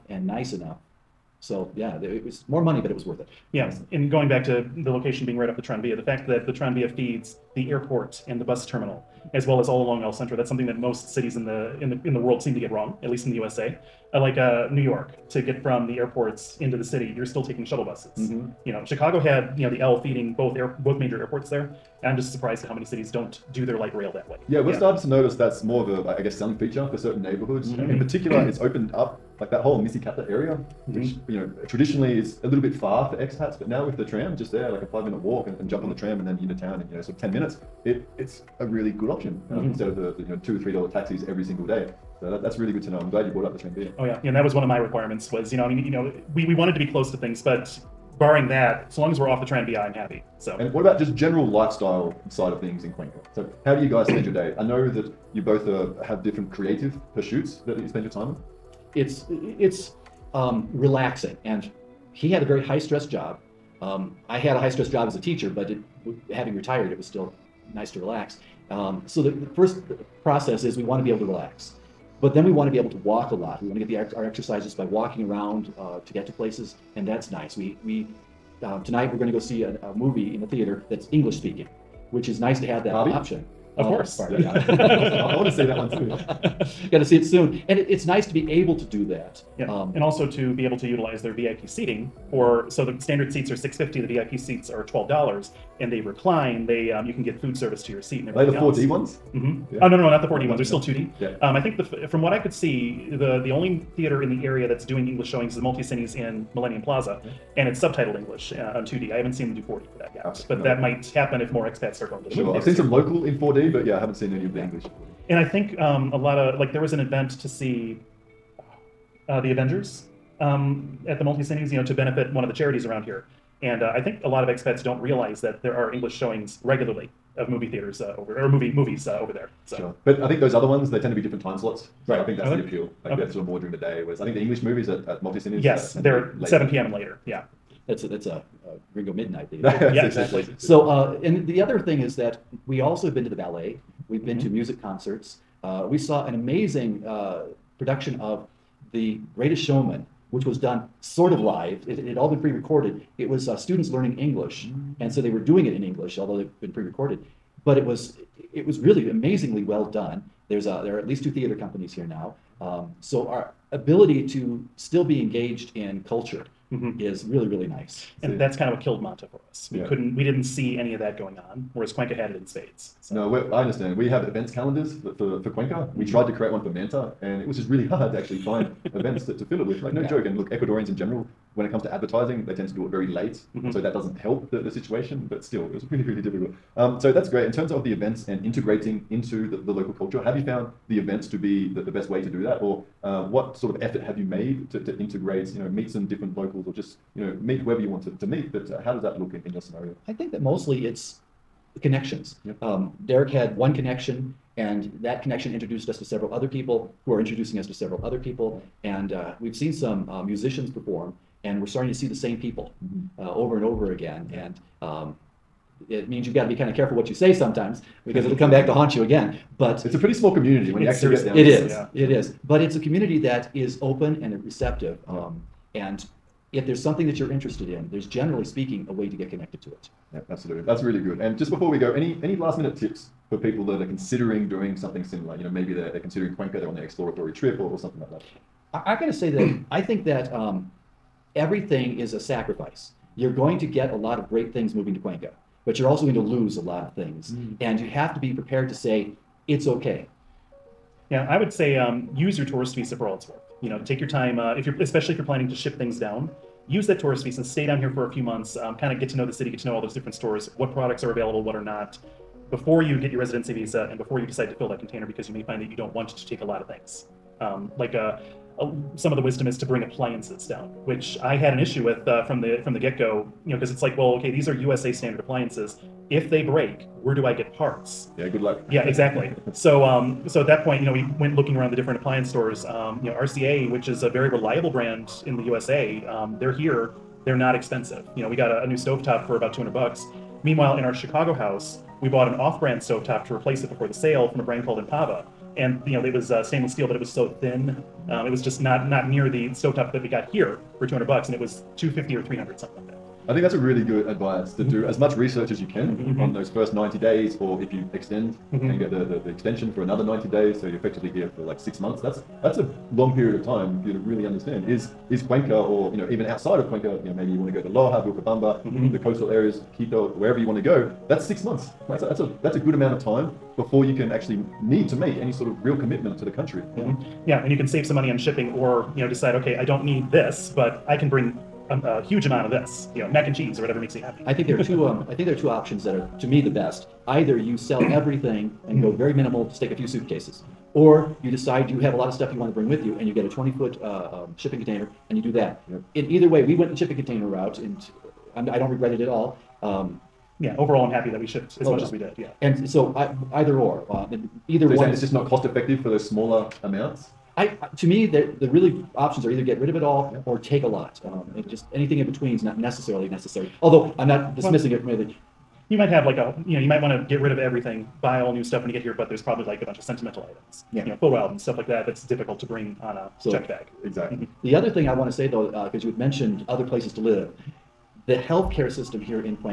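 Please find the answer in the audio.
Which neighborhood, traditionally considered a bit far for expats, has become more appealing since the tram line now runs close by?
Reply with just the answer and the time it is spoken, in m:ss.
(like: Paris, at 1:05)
Misicata, at 0:29.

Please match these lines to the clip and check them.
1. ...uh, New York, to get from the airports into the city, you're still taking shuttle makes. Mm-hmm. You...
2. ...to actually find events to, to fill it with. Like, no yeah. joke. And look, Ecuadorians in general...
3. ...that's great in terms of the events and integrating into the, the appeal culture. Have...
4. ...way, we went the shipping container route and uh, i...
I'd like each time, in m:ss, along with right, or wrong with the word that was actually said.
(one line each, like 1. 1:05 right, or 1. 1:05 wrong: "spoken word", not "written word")
1. 0:14 wrong: "buses", not "makes"
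2. 2:58 right
3. 3:07 wrong: "local", not "appeal"
4. 5:46 right.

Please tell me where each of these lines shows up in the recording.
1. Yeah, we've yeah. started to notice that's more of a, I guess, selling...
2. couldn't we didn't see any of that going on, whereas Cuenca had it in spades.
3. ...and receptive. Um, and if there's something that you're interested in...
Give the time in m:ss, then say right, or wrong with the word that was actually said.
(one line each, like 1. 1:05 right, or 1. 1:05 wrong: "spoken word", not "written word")
1. 0:24 right
2. 2:49 right
3. 3:44 right.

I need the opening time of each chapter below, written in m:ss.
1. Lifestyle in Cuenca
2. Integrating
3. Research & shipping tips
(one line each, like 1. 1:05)
1. 0:50
2. 3:06
3. 3:49.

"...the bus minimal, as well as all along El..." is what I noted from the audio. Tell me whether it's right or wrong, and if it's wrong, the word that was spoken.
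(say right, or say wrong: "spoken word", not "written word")
wrong: "terminal", not "minimal".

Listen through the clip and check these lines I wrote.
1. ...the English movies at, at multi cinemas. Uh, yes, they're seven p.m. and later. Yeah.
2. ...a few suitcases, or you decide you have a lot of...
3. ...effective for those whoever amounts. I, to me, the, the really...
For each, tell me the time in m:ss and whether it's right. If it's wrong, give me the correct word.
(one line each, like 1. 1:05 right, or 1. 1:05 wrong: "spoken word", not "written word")
1. 2:14 right
2. 5:39 right
3. 5:55 wrong: "smaller", not "whoever".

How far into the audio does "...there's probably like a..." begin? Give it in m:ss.
6:09.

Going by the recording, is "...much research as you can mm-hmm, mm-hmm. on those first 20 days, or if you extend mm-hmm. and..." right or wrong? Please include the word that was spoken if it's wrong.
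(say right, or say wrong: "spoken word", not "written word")
wrong: "90", not "20".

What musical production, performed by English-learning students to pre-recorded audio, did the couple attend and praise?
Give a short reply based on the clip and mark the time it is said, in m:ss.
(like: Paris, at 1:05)
The Greatest Showman, at 2:28.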